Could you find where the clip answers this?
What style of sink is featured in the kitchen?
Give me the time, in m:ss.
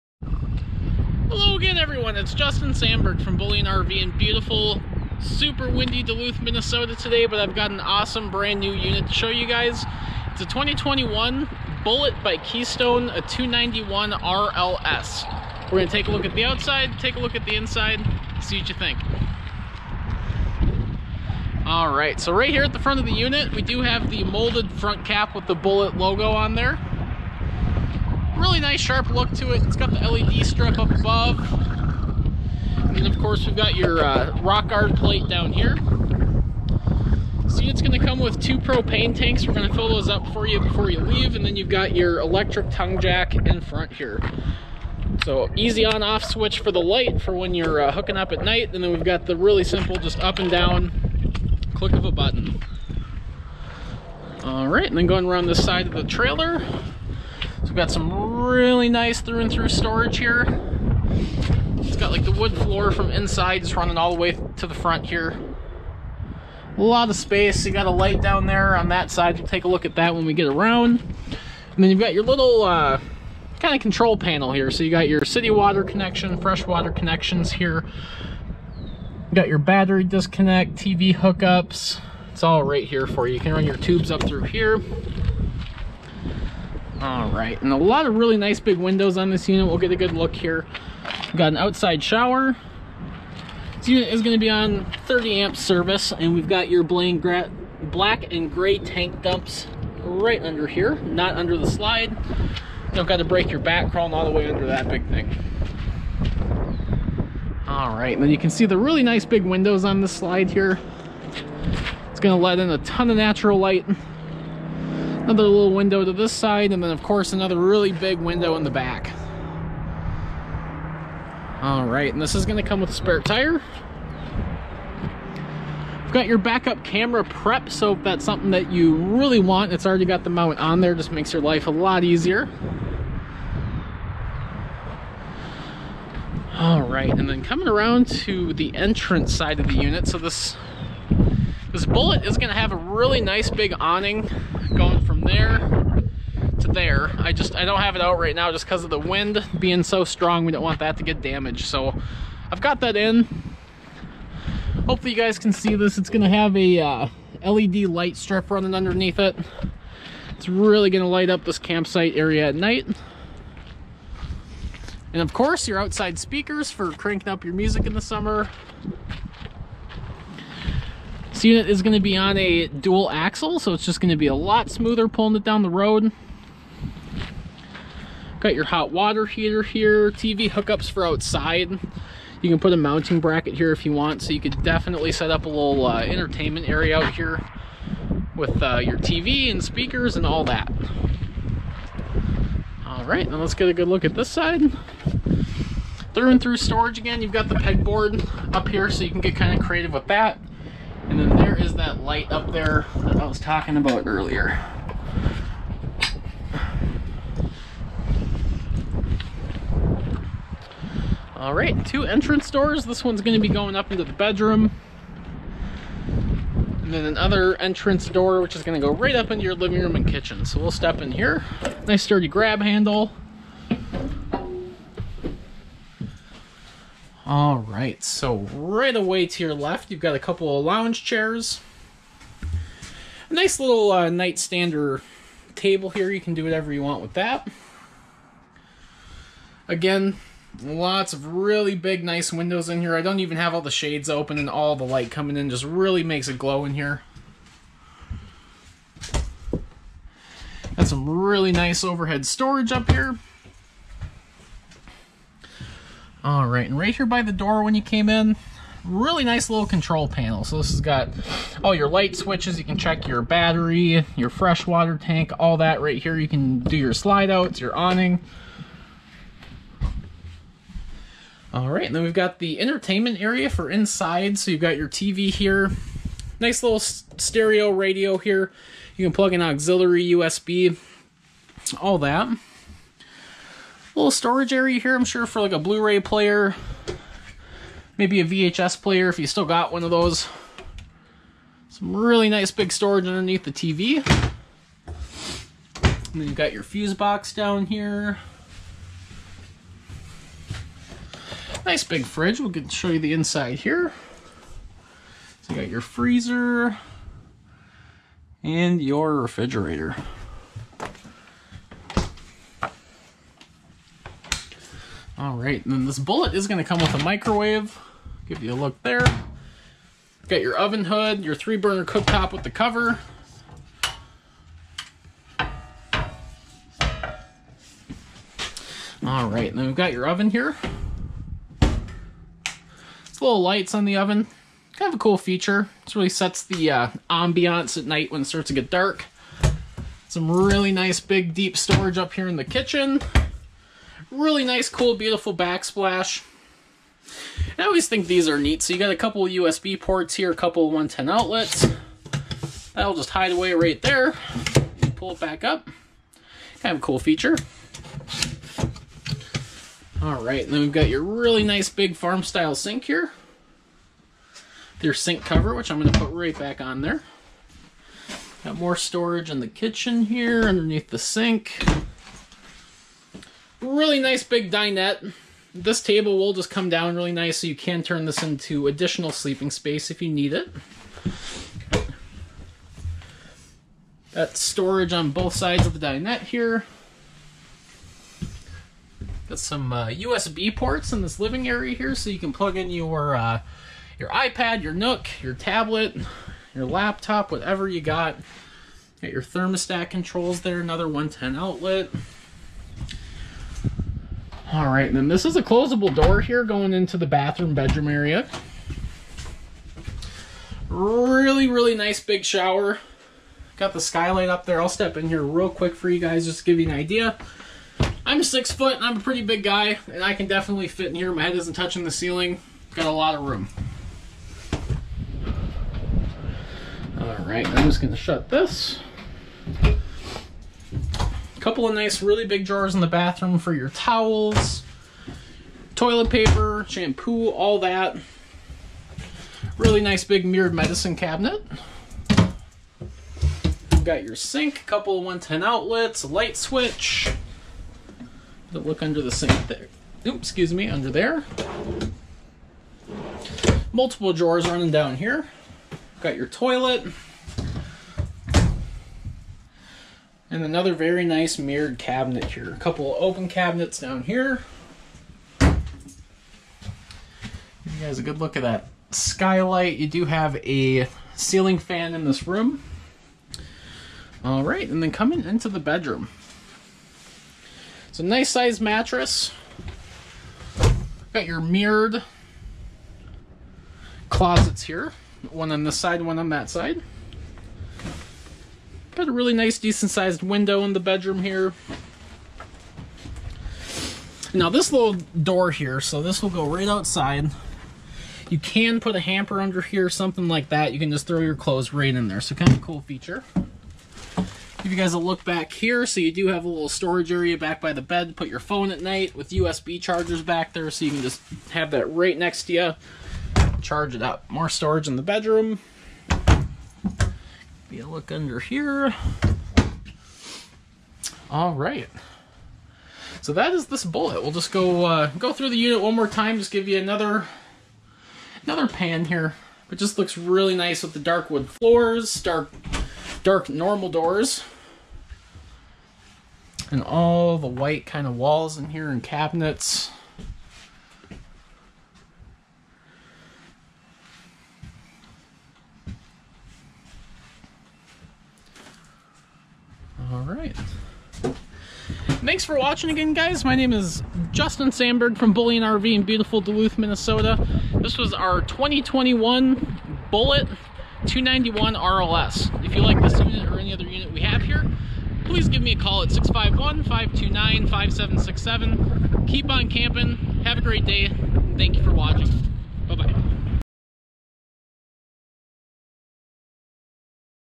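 6:01.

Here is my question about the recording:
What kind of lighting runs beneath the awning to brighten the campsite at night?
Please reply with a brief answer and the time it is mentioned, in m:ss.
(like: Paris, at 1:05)
LED light strip, at 2:37.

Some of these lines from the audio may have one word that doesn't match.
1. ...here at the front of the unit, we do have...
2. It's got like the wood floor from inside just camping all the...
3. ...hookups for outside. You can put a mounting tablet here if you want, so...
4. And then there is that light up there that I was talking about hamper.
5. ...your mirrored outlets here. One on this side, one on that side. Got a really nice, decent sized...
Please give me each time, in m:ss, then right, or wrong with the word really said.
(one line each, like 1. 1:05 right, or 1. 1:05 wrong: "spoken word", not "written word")
1. 0:22 right
2. 1:01 wrong: "running", not "camping"
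3. 3:00 wrong: "bracket", not "tablet"
4. 3:21 wrong: "earlier", not "hamper"
5. 8:01 wrong: "closets", not "outlets".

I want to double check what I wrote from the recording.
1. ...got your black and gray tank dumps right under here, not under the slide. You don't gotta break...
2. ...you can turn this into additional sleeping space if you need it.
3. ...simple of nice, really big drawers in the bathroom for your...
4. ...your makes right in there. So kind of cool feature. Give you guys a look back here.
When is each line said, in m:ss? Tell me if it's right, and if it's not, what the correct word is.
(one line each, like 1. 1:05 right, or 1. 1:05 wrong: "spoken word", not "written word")
1. 1:36 right
2. 6:17 right
3. 7:11 wrong: "couple", not "simple"
4. 8:21 wrong: "clothes", not "makes".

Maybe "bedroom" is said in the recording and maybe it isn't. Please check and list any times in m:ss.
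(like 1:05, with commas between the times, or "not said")
3:34, 6:47, 7:55, 8:10, 8:35.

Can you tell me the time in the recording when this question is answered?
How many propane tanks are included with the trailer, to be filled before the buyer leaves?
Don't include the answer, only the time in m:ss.
0:38.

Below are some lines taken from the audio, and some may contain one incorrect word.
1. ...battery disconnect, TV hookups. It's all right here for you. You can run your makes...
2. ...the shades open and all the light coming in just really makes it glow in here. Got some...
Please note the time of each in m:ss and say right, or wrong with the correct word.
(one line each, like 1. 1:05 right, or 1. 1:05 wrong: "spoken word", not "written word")
1. 1:19 wrong: "tubes", not "makes"
2. 4:03 right.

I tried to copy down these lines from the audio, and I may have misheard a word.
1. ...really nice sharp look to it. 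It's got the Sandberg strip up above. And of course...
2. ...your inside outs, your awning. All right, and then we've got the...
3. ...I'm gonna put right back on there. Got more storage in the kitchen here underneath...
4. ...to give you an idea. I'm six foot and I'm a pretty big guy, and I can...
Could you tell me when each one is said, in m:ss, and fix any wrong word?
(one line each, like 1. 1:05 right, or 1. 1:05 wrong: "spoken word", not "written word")
1. 0:28 wrong: "LED", not "Sandberg"
2. 4:26 wrong: "slide", not "inside"
3. 6:05 right
4. 6:56 right.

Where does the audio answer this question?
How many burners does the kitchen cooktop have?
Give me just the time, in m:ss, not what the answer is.
5:21.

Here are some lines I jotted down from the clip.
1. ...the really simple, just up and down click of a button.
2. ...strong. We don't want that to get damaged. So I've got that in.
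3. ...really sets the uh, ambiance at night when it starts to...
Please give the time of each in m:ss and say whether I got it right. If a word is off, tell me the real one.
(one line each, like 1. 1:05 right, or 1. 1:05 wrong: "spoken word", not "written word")
1. 0:49 right
2. 2:30 right
3. 5:35 right.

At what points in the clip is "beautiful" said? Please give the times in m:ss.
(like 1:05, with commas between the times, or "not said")
0:04, 5:44, 9:16.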